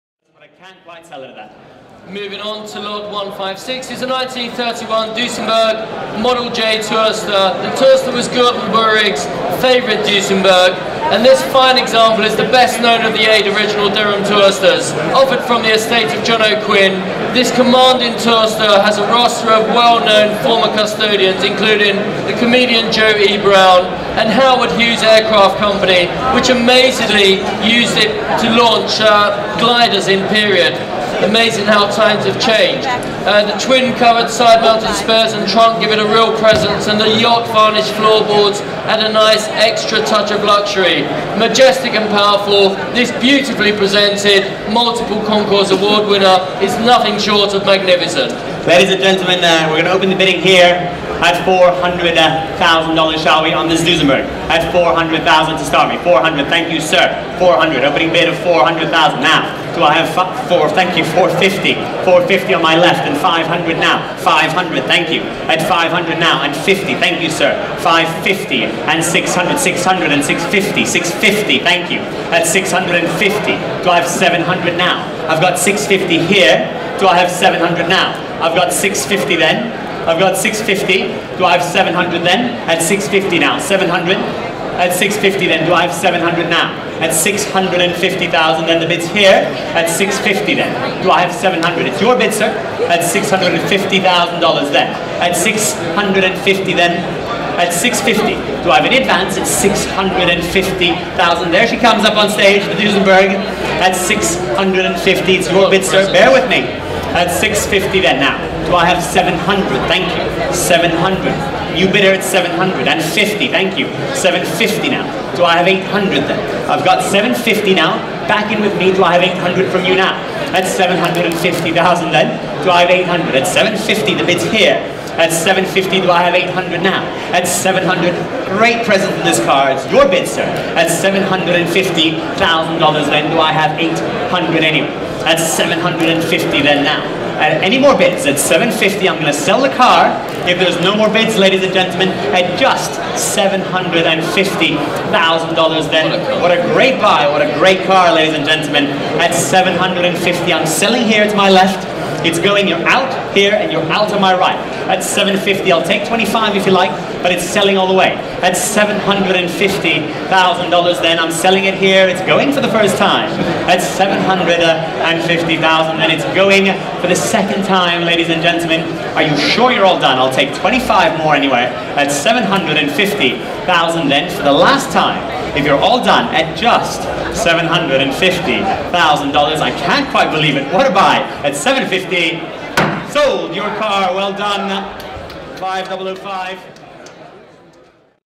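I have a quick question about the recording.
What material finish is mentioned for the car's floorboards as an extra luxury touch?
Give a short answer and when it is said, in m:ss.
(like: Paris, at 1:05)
yacht varnished, at 0:37.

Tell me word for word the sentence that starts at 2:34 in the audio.
At 750, I'll take 25 if you like, but it's selling all the way.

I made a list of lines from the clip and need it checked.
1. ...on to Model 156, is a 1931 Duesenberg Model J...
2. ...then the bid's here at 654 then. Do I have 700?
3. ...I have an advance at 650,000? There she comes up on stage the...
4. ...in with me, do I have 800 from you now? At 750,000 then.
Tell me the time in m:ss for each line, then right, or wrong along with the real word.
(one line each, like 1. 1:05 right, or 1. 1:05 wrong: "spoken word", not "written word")
1. 0:02 wrong: "Lord", not "Model"
2. 1:28 wrong: "650", not "654"
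3. 1:38 right
4. 1:58 right.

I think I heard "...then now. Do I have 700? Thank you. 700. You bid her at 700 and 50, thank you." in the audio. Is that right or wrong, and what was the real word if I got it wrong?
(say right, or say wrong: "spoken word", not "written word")
right.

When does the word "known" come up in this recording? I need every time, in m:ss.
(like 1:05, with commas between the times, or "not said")
0:12, 0:19.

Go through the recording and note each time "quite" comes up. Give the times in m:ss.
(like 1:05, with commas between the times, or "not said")
0:00, 3:00.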